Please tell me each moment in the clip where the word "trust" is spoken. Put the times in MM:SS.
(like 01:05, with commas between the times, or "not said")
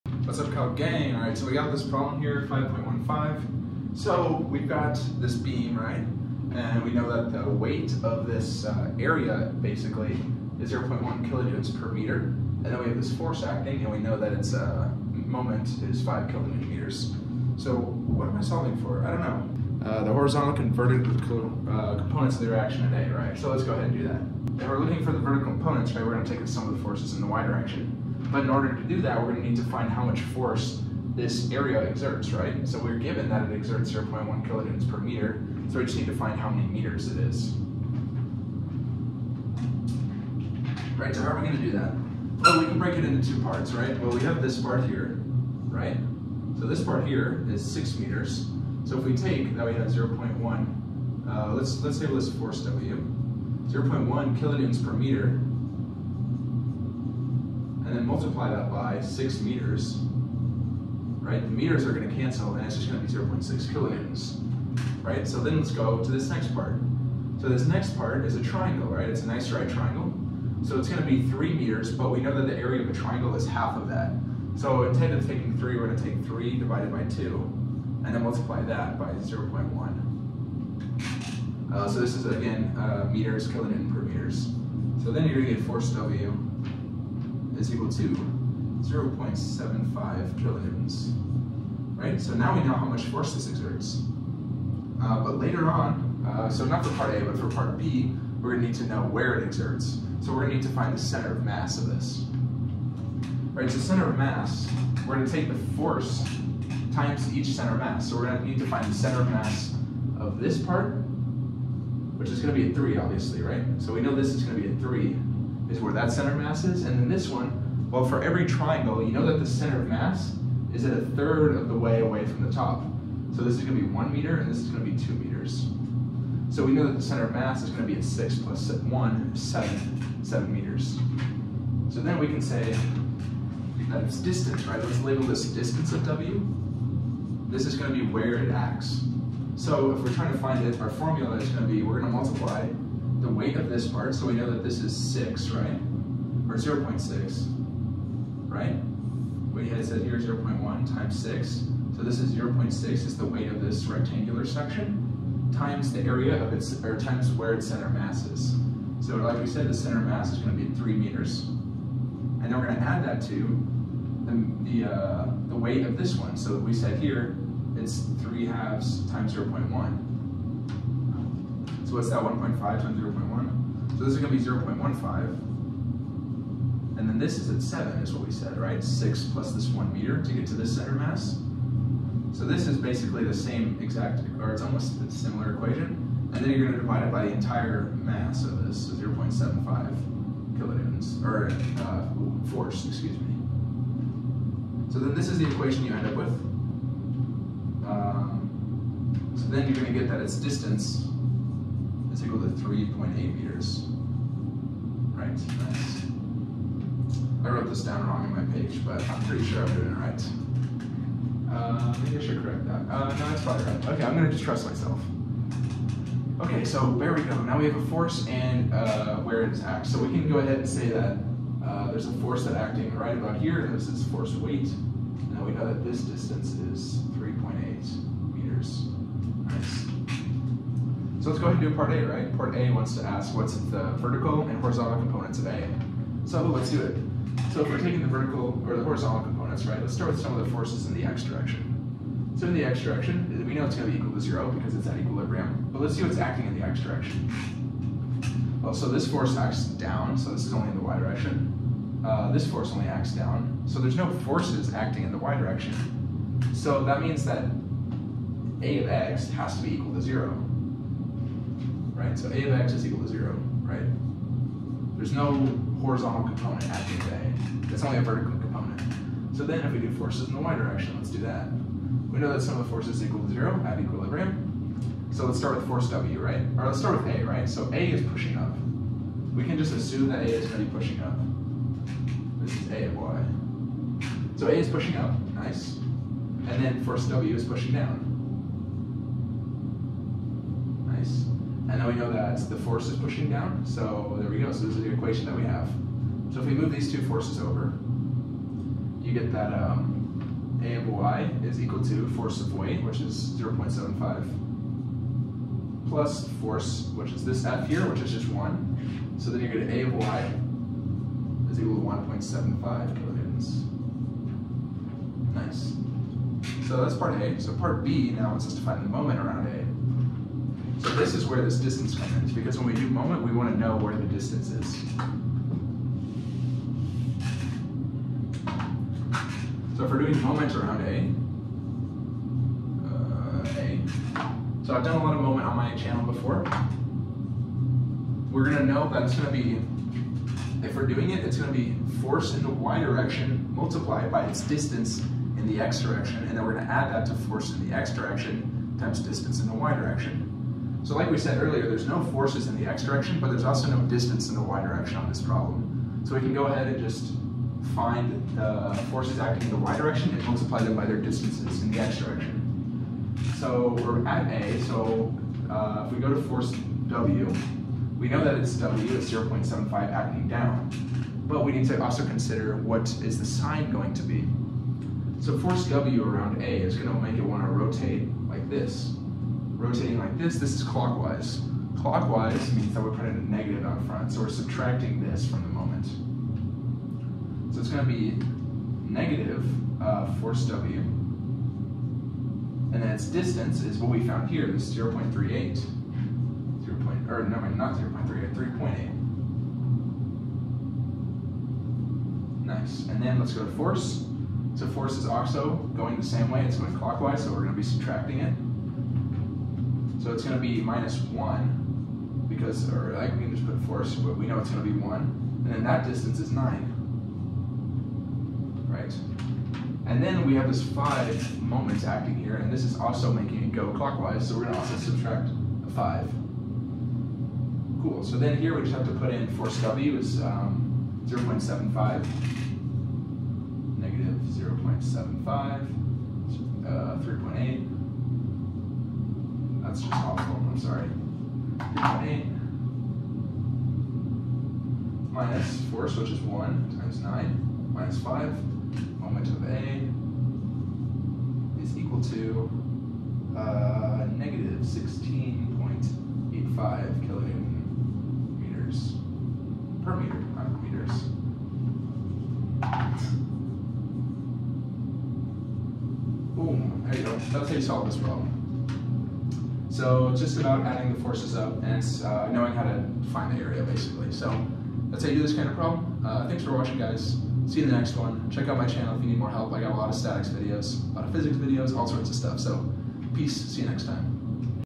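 03:34.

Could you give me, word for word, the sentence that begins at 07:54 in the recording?
So that's how you do this kind of problem.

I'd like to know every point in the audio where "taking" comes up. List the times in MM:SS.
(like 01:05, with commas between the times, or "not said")
01:15, 03:57.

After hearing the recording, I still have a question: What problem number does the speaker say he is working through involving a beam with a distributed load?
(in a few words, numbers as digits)
5.15.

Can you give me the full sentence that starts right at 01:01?
The meters are gonna cancel and it's just gonna be 0.6 kilonewtons.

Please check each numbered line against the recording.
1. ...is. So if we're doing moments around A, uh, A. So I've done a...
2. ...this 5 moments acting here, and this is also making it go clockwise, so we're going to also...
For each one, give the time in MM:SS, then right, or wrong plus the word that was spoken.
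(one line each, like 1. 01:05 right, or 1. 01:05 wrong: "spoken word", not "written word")
1. 05:24 right
2. 07:00 right.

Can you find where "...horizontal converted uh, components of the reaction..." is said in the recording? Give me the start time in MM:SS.
00:20.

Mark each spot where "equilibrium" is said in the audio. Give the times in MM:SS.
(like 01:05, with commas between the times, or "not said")
04:04, 04:33.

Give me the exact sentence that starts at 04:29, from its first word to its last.
So then if we do forces in the y direction, let's do that.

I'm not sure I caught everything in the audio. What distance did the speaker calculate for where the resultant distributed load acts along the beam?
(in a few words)
3.8 meters.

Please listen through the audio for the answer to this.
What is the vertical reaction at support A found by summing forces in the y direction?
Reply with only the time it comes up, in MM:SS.
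05:11.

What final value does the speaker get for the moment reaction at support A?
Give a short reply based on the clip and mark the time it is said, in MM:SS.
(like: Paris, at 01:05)
-16.85 kN·m, at 07:34.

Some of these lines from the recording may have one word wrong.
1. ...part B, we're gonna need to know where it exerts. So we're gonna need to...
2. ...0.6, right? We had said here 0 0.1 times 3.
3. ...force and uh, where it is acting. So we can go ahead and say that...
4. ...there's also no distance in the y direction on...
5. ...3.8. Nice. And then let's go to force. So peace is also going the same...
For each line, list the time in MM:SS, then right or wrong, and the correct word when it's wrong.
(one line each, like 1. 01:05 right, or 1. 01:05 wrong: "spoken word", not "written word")
1. 01:37 right
2. 02:26 wrong: "6", not "3"
3. 03:37 right
4. 05:53 right
5. 06:38 wrong: "force", not "peace".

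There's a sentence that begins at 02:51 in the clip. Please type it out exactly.
So what's that, 1.5 times 0 0.1?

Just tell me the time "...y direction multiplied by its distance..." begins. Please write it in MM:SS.
05:42.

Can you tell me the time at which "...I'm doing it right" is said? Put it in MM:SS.
03:29.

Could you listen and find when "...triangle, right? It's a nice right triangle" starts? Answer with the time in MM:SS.
01:08.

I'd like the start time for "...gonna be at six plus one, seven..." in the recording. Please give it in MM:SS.
02:07.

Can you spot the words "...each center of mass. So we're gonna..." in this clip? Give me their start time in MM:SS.
01:47.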